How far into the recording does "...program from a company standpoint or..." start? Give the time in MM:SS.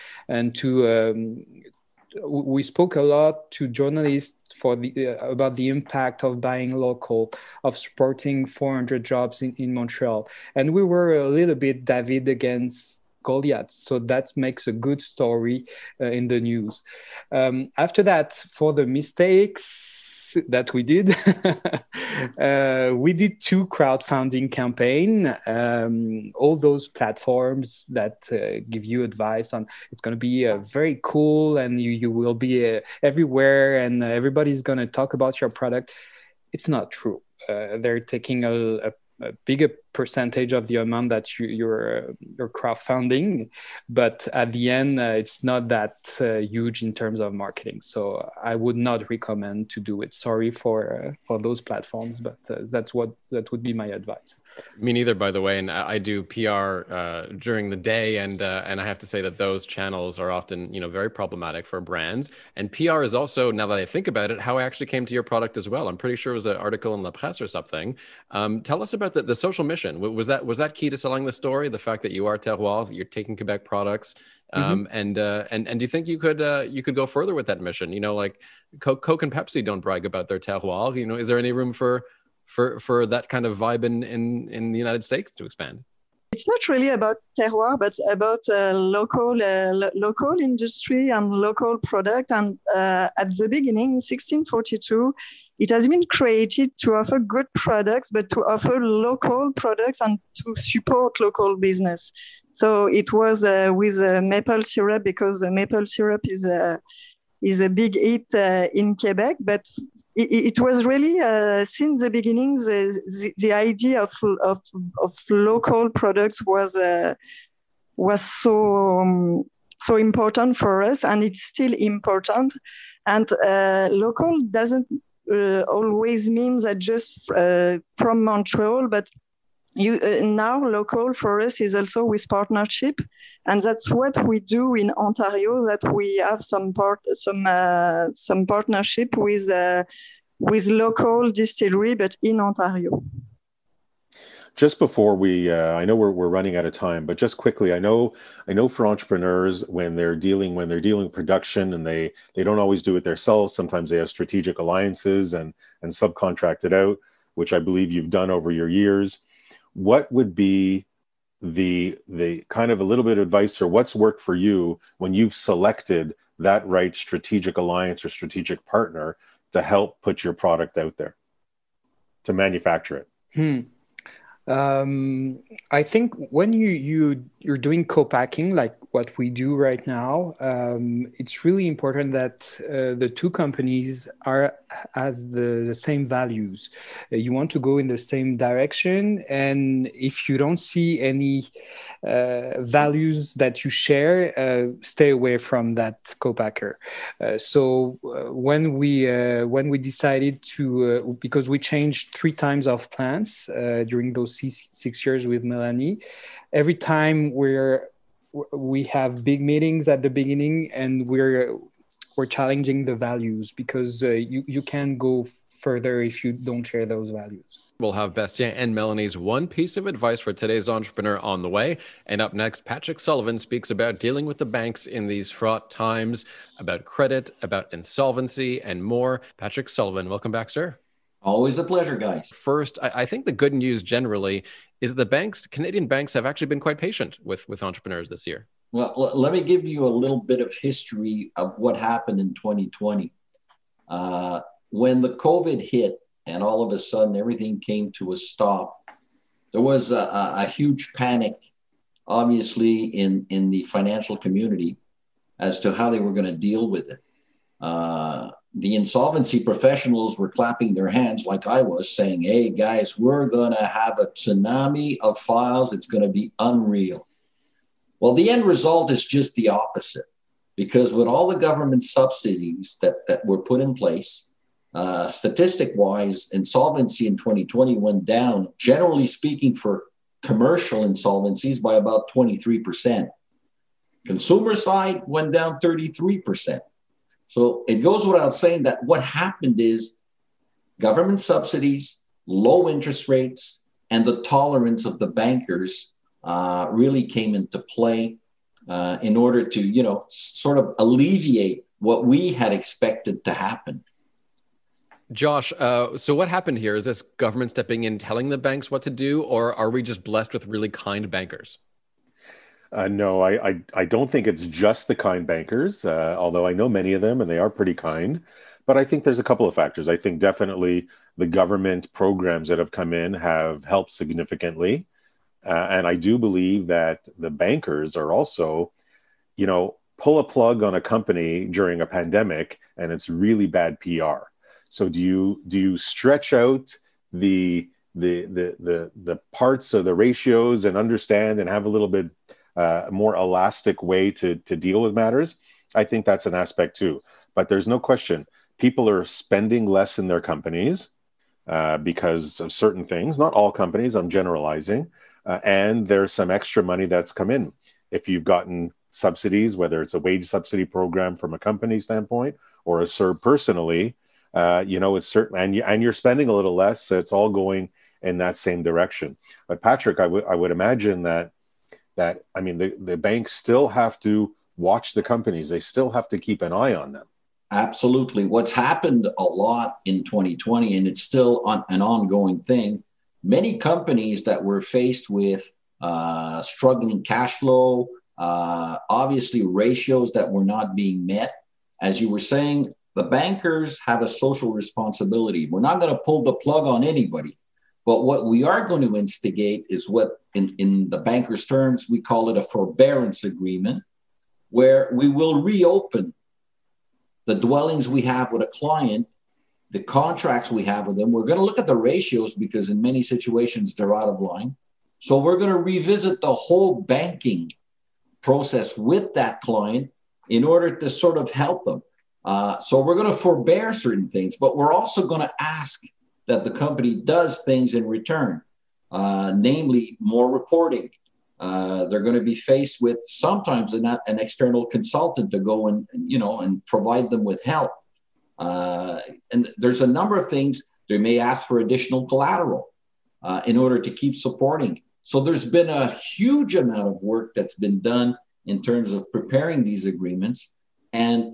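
06:00.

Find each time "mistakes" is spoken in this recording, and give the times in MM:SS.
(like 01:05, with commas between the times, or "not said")
00:18.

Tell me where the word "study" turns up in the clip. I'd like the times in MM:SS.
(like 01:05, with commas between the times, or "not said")
not said.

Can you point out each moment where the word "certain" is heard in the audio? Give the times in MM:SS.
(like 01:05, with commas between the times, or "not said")
05:52, 06:05, 07:03.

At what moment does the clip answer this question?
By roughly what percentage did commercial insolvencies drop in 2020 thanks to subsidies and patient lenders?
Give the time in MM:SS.
04:42.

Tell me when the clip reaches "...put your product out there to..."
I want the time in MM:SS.
02:50.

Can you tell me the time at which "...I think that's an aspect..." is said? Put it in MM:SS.
05:45.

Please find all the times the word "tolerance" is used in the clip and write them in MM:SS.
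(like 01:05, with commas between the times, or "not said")
04:54.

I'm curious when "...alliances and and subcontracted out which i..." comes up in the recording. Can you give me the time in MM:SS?
02:34.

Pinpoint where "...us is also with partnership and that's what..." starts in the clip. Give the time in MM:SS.
02:11.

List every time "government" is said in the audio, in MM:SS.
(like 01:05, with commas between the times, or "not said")
04:31, 04:50, 05:07, 05:21.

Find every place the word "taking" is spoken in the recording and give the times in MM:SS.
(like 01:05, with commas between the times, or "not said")
00:38, 01:13.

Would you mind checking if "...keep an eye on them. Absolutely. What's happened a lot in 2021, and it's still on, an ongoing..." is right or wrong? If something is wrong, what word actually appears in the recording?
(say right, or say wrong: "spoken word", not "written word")
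wrong: "2020", not "2021".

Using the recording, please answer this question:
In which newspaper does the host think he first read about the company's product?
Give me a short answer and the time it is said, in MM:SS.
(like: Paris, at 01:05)
La Presse, at 01:07.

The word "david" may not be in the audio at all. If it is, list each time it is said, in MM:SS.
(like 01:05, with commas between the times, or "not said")
00:11.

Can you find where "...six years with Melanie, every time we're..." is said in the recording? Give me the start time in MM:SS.
03:24.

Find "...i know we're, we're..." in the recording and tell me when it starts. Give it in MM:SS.
02:25.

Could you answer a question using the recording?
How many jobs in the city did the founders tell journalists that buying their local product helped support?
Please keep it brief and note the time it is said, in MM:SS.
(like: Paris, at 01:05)
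400, at 00:08.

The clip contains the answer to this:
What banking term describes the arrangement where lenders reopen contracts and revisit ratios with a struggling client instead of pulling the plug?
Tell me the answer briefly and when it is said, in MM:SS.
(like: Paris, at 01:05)
forbearance agreement, at 06:42.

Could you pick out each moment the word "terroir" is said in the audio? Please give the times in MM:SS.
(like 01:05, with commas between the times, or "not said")
01:12, 01:20, 01:27.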